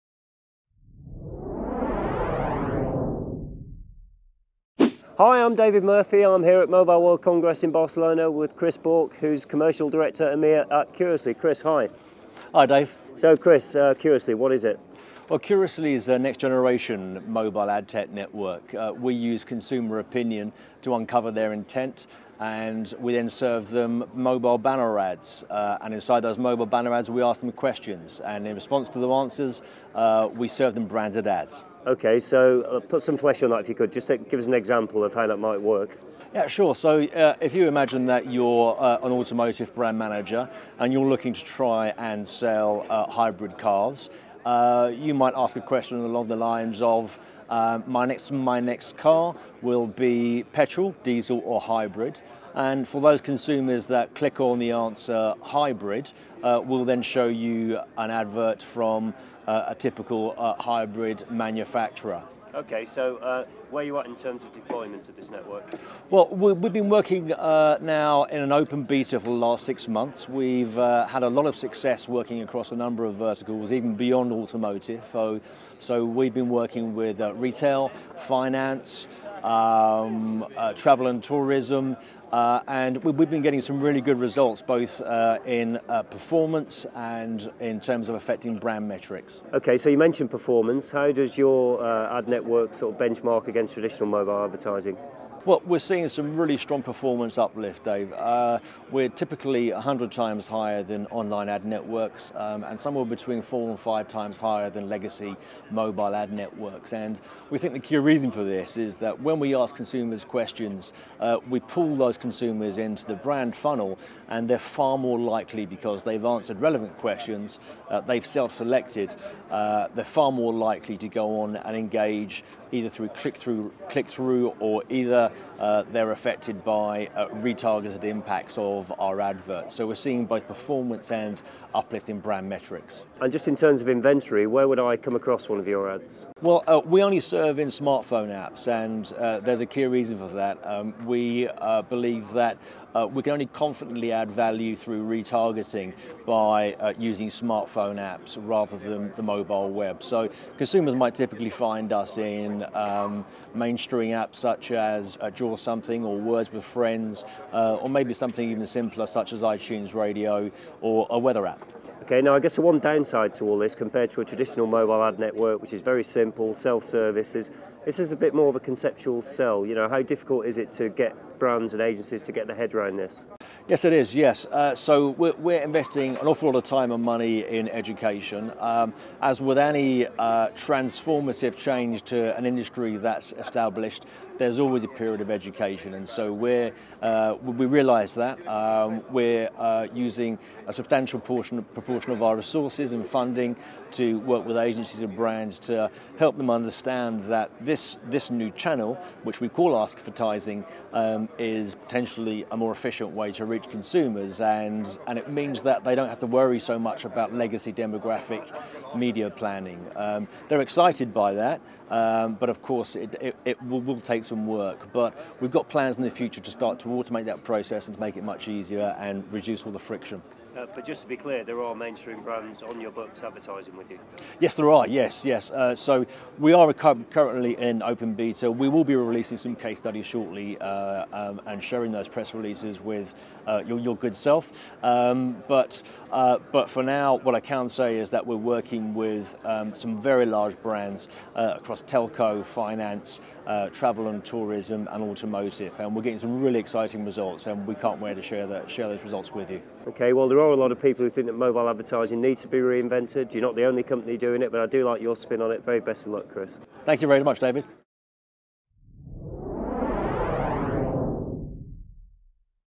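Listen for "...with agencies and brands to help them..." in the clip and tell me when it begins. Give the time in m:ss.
3:14.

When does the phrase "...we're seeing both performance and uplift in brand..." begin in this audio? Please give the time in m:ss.
2:09.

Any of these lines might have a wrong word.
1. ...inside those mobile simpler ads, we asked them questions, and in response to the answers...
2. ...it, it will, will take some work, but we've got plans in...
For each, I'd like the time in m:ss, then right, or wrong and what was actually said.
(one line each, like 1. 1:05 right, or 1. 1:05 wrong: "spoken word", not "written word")
1. 0:25 wrong: "banner", not "simpler"
2. 3:33 right.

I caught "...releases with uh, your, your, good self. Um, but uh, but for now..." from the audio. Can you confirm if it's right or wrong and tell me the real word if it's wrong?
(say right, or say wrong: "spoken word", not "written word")
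right.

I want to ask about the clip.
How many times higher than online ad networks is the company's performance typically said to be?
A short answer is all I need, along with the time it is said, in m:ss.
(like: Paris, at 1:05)
100, at 1:39.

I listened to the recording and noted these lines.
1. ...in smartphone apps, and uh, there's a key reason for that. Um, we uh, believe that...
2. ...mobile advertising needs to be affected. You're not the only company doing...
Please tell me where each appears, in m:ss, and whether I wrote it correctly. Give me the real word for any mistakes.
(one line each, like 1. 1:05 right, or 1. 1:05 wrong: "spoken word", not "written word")
1. 2:17 right
2. 4:11 wrong: "reinvented", not "affected".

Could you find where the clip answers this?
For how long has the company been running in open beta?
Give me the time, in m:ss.
1:09.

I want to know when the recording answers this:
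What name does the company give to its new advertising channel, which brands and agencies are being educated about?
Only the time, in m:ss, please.
3:19.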